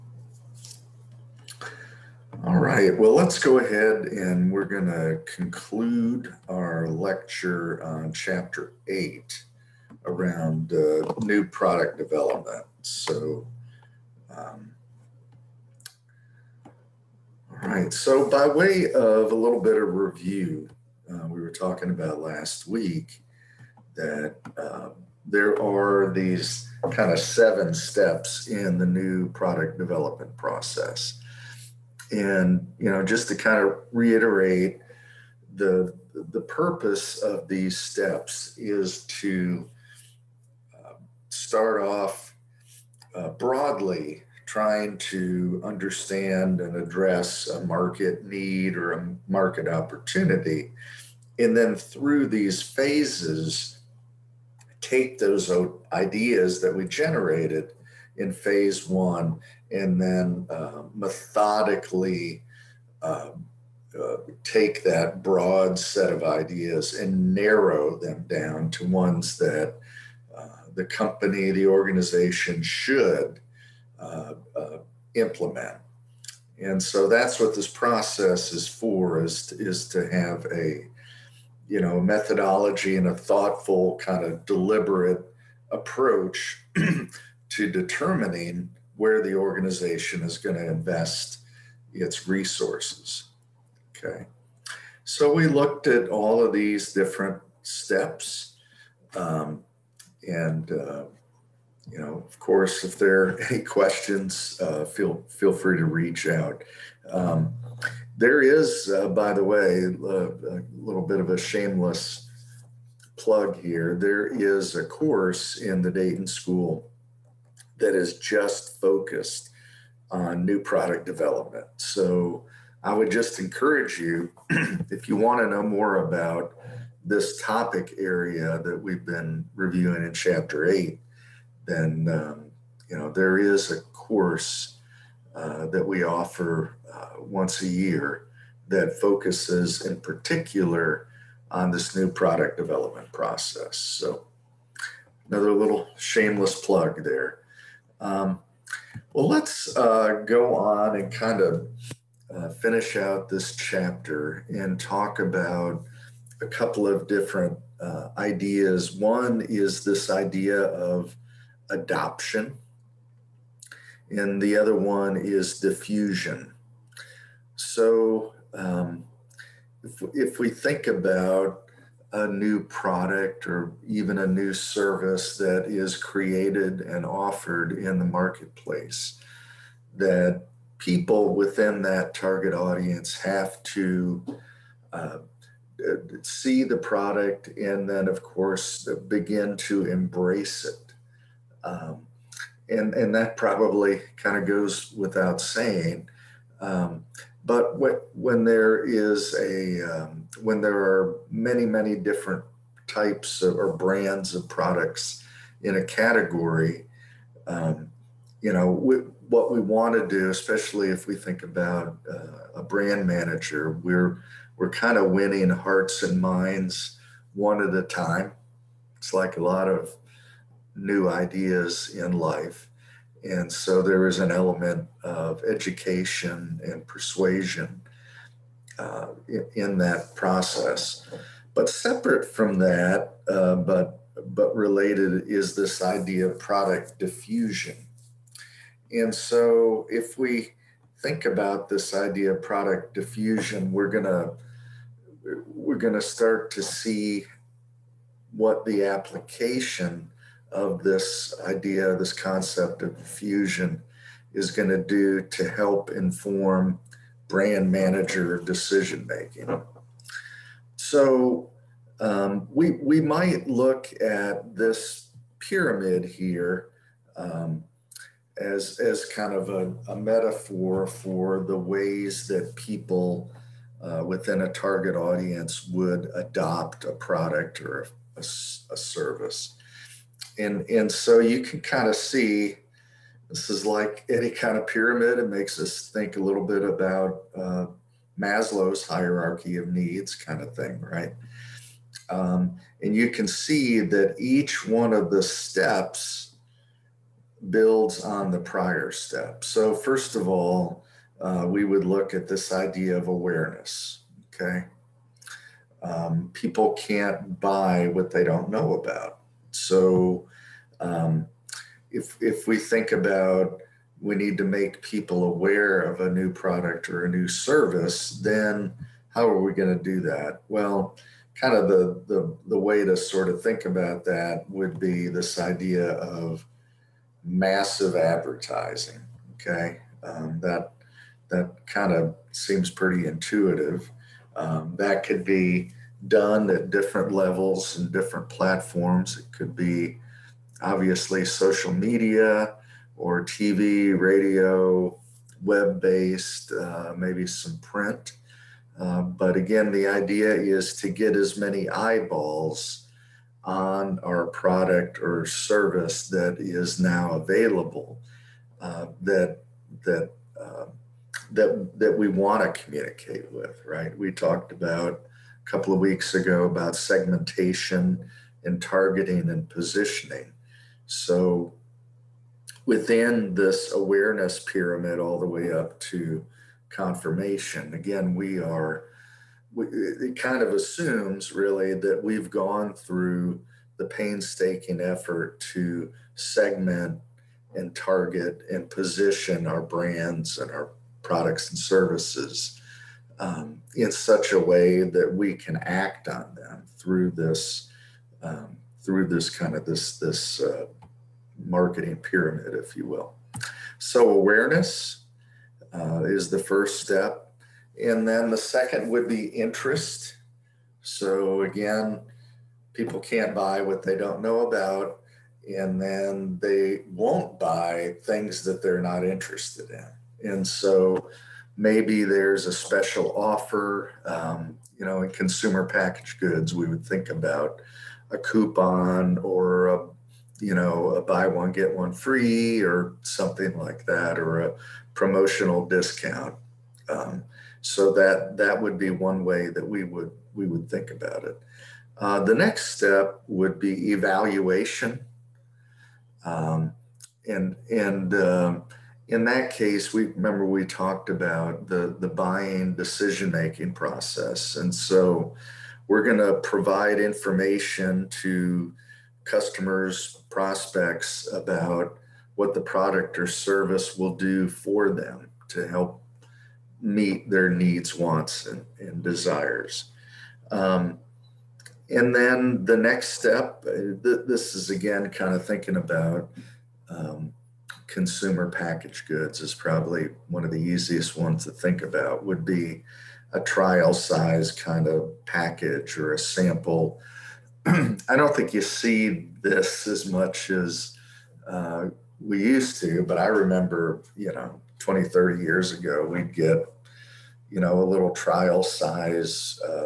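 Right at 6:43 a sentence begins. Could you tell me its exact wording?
So awareness uh, is the first step, and then the second would be interest.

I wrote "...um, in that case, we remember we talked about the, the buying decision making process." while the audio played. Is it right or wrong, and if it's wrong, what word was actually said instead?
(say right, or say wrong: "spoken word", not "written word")
right.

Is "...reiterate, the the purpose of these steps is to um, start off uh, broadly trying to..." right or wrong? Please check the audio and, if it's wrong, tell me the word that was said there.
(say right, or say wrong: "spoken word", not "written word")
right.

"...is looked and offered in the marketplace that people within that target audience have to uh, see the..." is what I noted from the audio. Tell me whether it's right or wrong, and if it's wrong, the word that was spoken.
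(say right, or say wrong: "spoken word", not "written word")
wrong: "created", not "looked".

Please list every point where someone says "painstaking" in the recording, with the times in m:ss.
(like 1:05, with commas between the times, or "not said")
6:23.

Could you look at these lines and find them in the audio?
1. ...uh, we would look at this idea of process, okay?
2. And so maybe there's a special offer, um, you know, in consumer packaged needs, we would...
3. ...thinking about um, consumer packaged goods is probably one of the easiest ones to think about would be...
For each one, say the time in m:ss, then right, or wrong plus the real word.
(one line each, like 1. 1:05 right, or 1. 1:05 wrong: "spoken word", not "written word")
1. 5:01 wrong: "awareness", not "process"
2. 7:00 wrong: "goods", not "needs"
3. 7:55 right.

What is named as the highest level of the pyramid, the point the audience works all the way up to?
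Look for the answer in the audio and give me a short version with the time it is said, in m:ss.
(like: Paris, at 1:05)
confirmation, at 6:16.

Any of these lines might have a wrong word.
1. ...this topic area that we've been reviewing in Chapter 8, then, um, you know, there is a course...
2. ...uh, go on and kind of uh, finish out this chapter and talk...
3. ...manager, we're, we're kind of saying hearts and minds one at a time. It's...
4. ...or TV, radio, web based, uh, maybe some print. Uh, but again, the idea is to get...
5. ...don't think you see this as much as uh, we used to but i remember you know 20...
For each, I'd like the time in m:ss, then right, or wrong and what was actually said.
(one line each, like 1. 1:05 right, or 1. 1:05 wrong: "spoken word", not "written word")
1. 2:07 right
2. 2:29 right
3. 3:33 wrong: "winning", not "saying"
4. 5:42 right
5. 8:08 right.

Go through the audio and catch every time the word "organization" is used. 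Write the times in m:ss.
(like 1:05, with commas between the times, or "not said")
1:11, 1:29.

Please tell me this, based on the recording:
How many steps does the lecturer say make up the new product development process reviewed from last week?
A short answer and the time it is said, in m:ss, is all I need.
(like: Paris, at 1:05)
7, at 0:27.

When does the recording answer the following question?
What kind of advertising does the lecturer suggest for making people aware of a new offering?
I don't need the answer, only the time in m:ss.
5:27.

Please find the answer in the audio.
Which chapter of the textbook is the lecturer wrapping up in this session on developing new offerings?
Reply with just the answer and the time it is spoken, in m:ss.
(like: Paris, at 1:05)
Chapter 8, at 0:08.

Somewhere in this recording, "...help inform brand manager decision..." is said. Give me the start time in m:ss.
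4:15.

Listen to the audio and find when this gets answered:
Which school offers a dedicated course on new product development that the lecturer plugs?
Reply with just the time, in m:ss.
1:55.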